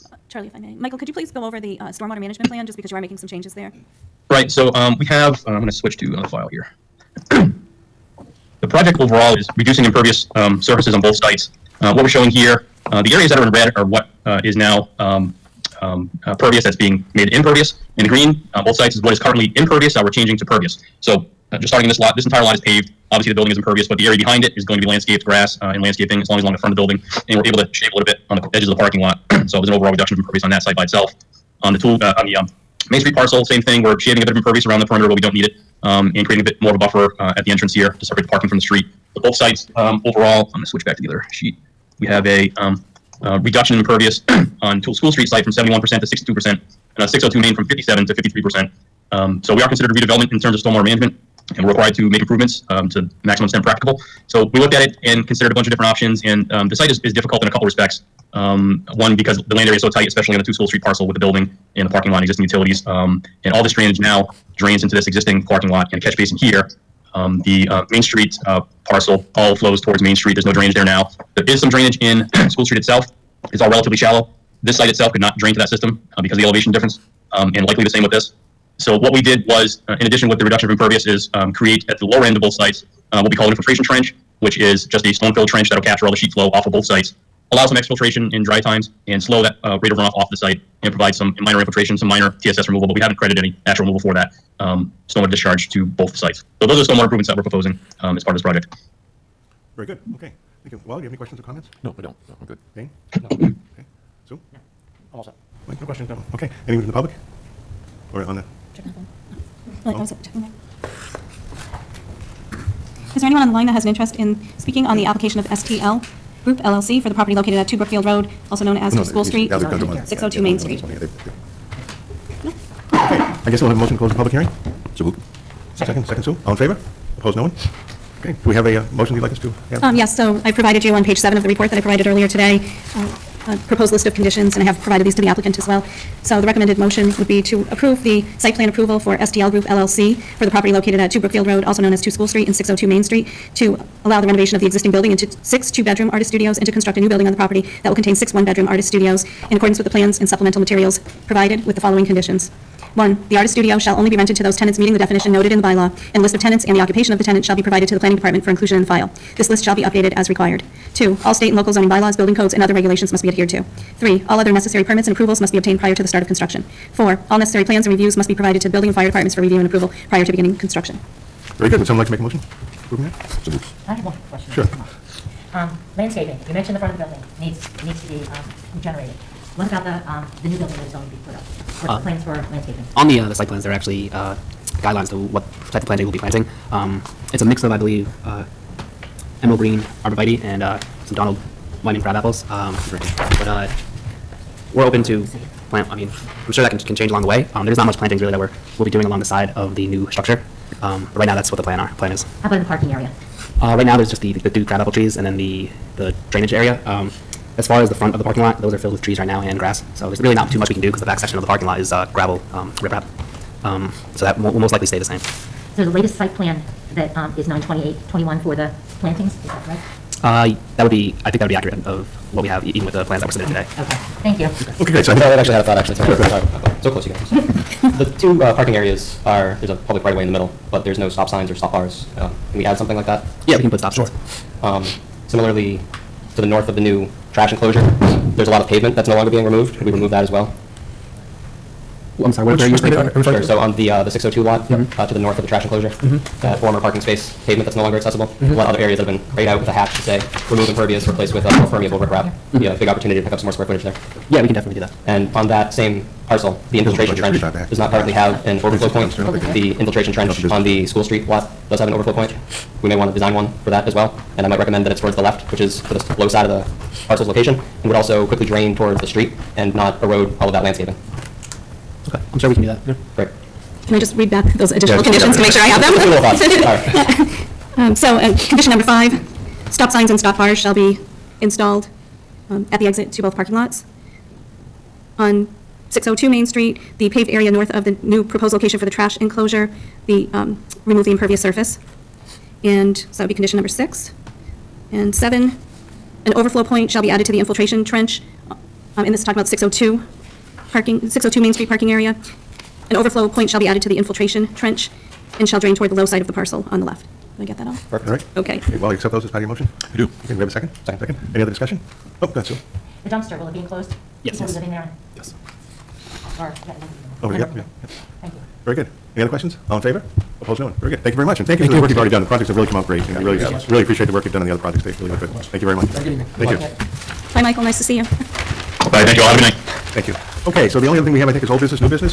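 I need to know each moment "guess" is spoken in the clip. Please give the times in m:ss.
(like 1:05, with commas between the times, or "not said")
2:03.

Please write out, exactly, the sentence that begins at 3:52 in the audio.
Um, can we add something like that?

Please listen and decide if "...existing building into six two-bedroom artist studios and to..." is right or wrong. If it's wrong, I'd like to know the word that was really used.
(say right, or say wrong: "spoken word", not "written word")
right.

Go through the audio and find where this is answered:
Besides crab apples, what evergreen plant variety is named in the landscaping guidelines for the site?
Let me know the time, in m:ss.
3:09.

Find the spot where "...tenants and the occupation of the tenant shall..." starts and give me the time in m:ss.
2:36.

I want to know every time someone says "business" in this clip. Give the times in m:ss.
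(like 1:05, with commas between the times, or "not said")
5:31.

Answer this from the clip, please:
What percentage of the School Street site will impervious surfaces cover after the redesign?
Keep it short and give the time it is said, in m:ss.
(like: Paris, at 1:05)
62%, at 0:46.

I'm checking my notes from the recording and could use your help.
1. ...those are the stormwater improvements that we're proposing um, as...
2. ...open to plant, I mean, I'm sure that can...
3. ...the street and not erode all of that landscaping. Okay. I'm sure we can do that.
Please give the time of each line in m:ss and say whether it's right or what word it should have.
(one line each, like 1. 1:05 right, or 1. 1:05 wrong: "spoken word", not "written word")
1. 1:36 right
2. 3:14 right
3. 4:29 right.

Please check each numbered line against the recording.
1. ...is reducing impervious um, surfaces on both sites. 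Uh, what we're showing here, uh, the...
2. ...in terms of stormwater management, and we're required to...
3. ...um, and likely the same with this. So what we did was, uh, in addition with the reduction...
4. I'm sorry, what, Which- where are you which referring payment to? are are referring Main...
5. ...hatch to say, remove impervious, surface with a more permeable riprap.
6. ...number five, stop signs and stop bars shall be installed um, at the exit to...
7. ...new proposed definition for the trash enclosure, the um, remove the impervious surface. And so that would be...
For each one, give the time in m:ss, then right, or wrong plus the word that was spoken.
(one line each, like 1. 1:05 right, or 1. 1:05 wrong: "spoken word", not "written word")
1. 0:09 right
2. 0:50 right
3. 1:17 right
4. 4:02 wrong: "Sure", not "Main"
5. 4:09 wrong: "replace", not "surface"
6. 4:38 right
7. 4:48 wrong: "location", not "definition".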